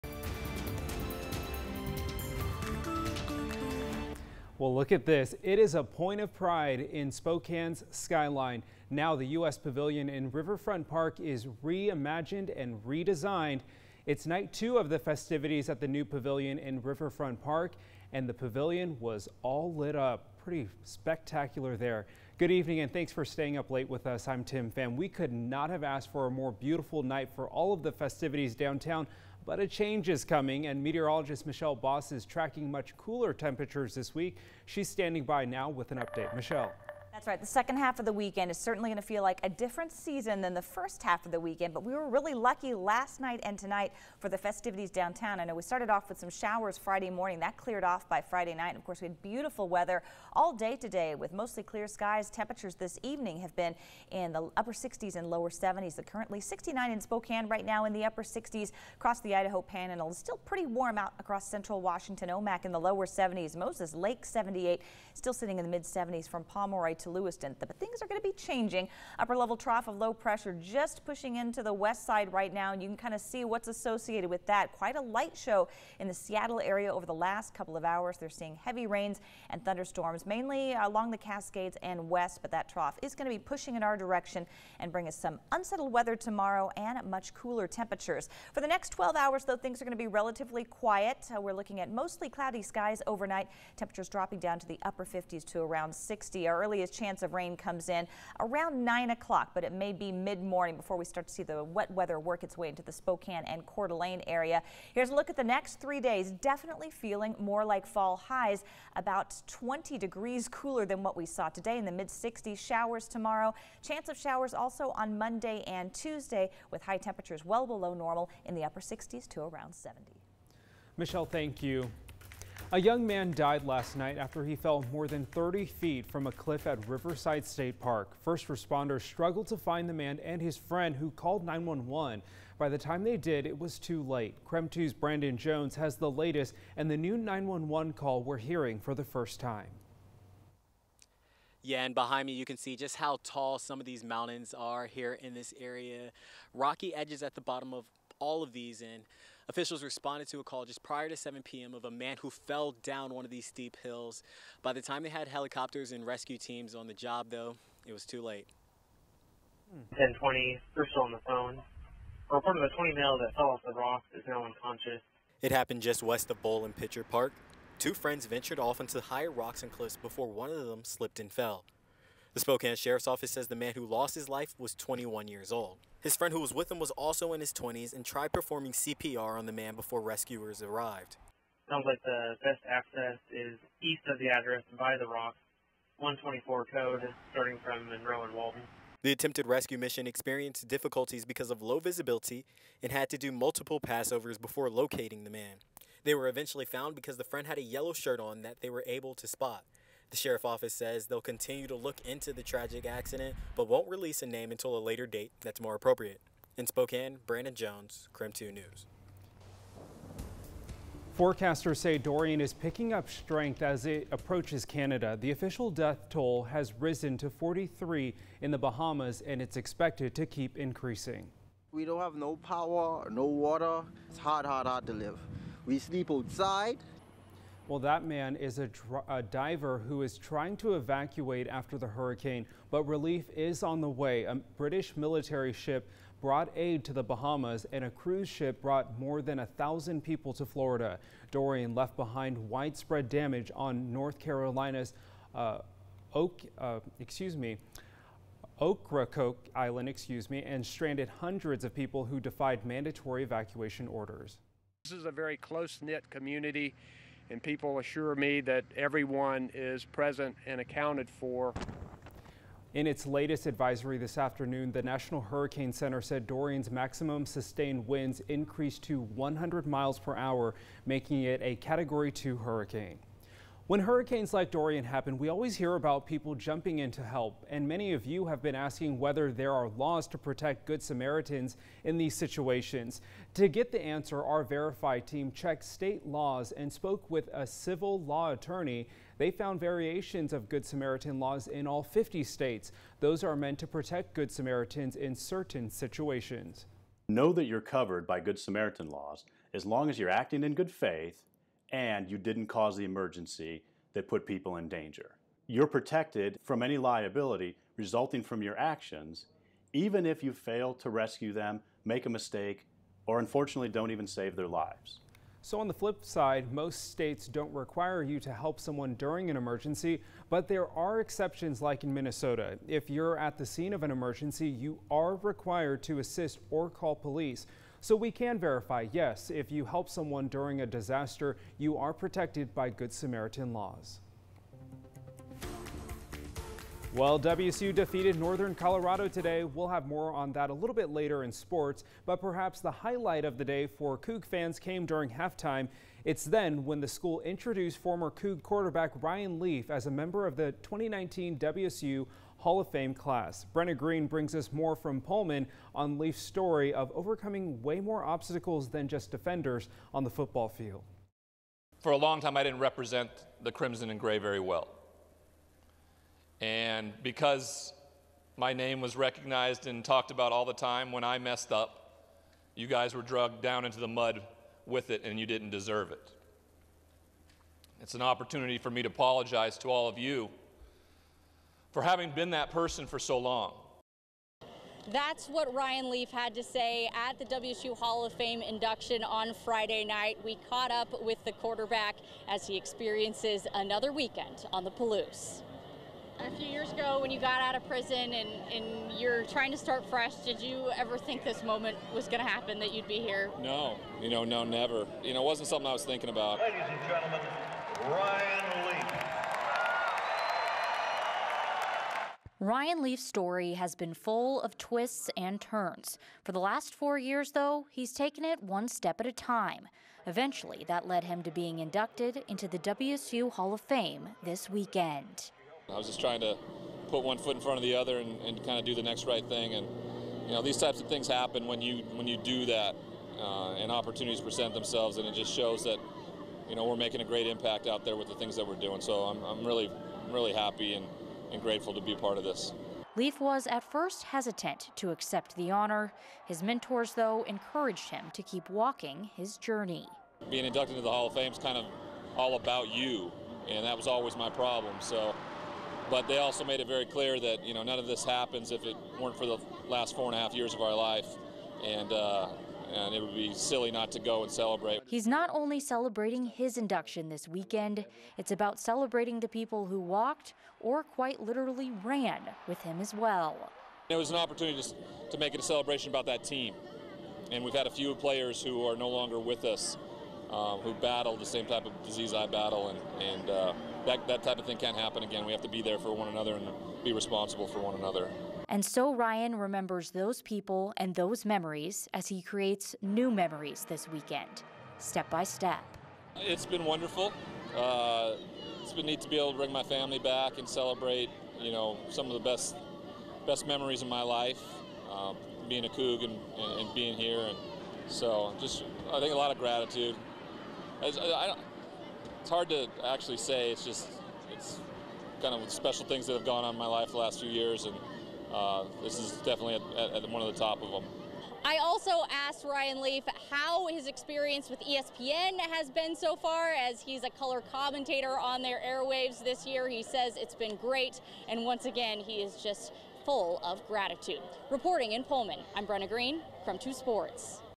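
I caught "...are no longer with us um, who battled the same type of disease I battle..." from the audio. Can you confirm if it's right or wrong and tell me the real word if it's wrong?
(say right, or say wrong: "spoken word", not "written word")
right.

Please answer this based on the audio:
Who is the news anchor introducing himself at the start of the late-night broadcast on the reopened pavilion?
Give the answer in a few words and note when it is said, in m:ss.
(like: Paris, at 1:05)
Tim Pham, at 0:24.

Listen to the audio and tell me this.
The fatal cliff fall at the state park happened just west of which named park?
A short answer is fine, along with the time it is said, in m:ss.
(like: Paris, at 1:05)
Bowl and Pitcher Park, at 2:46.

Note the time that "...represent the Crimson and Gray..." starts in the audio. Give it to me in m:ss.
6:02.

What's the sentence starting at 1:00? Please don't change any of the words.
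still pretty warm out across central Washington.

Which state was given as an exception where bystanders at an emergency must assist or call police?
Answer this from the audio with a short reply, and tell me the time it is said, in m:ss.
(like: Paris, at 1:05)
Minnesota, at 5:21.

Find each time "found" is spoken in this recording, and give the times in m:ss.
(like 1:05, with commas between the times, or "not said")
3:16, 4:49.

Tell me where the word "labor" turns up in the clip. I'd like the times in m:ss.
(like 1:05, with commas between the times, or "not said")
not said.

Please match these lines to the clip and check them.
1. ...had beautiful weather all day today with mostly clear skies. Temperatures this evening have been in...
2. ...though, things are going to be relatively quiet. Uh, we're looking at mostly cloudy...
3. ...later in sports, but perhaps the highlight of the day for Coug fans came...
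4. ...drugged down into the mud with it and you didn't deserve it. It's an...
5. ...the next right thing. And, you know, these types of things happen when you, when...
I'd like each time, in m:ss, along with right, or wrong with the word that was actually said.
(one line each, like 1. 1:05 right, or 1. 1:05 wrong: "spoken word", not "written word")
1. 0:49 right
2. 1:29 right
3. 5:40 right
4. 6:13 right
5. 7:08 right.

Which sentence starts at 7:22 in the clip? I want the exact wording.
Leaf was at first hesitant to accept the honor.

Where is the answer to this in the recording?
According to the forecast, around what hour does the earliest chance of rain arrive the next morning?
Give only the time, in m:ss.
1:38.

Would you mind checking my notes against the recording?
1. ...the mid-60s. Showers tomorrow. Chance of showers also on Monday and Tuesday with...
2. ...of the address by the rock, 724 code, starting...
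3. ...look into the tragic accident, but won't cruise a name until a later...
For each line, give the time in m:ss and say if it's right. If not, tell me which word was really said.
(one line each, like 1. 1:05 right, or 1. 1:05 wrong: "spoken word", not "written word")
1. 1:51 right
2. 3:04 wrong: "124", not "724"
3. 3:21 wrong: "release", not "cruise".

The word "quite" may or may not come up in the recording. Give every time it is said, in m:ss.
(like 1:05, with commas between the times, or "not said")
1:14, 7:50.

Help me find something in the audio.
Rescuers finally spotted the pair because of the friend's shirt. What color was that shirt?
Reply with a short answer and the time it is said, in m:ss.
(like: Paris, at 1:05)
Yellow, at 3:17.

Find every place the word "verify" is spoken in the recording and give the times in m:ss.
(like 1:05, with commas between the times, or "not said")
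4:44, 5:28.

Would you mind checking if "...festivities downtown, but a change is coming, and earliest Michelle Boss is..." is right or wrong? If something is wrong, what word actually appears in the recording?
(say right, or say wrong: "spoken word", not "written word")
wrong: "meteorologist", not "earliest".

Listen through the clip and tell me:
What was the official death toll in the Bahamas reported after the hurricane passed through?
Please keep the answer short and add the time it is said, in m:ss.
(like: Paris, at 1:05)
43, at 3:37.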